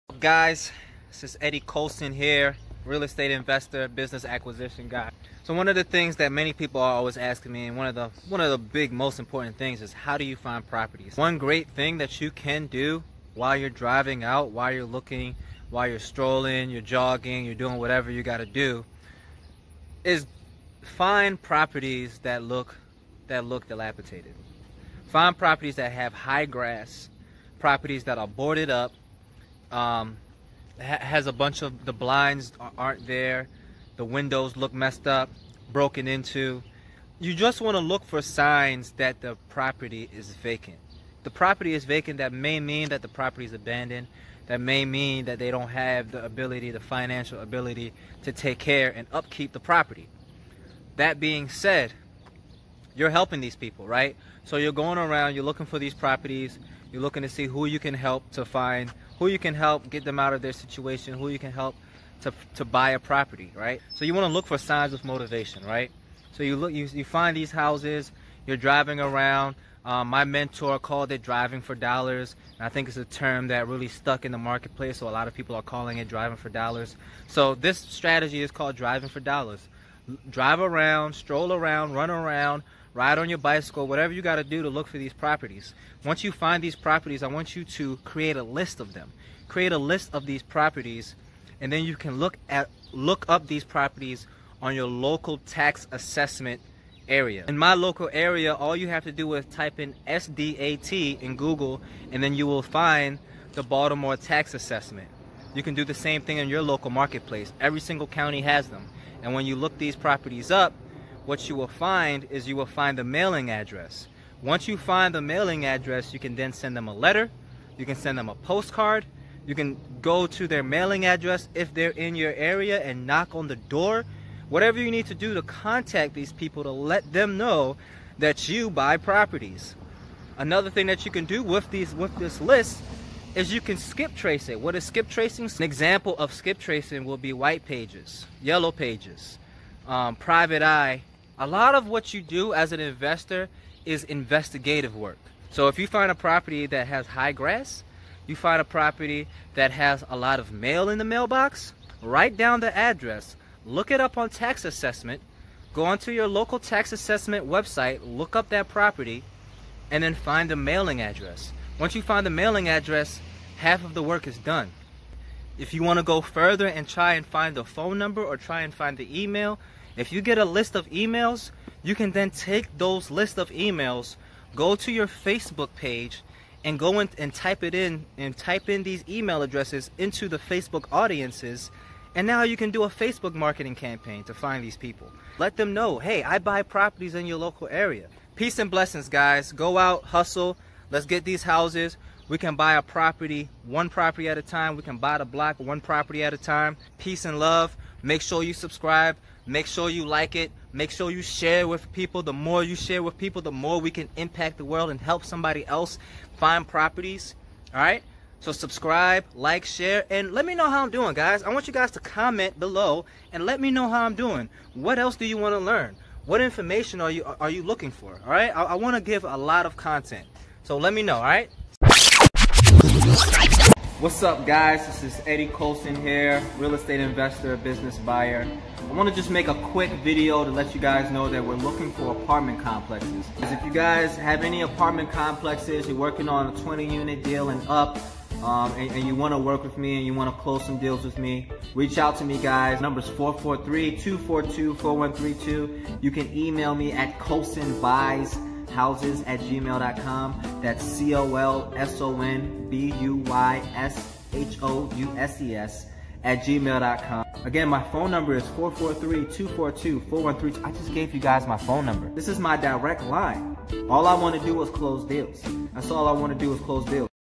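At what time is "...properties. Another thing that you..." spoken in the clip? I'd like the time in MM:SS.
02:08.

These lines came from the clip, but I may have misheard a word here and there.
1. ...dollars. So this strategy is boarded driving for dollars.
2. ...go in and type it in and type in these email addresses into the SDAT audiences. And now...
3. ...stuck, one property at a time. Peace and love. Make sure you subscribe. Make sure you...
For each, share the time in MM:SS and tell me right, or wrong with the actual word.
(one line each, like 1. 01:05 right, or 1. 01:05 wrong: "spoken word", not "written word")
1. 01:16 wrong: "called", not "boarded"
2. 02:56 wrong: "Facebook", not "SDAT"
3. 03:15 wrong: "block", not "stuck".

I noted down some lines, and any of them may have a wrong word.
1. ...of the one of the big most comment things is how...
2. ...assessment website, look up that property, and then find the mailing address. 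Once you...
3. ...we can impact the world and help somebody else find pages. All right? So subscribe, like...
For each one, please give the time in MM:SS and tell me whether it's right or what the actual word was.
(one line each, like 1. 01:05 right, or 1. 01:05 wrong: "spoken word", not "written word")
1. 00:07 wrong: "important", not "comment"
2. 02:36 right
3. 03:23 wrong: "properties", not "pages".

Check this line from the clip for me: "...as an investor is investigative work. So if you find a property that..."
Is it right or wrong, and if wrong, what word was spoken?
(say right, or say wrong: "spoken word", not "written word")
right.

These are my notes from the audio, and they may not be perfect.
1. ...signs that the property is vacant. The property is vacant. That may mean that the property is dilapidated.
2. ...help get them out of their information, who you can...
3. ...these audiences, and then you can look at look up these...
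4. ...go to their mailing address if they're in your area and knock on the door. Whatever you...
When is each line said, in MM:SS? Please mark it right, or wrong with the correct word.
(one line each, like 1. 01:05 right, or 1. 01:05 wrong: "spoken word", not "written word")
1. 00:38 wrong: "abandoned", not "dilapidated"
2. 00:59 wrong: "situation", not "information"
3. 01:30 wrong: "properties", not "audiences"
4. 02:00 right.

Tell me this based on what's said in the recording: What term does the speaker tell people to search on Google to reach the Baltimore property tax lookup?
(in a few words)
SDAT.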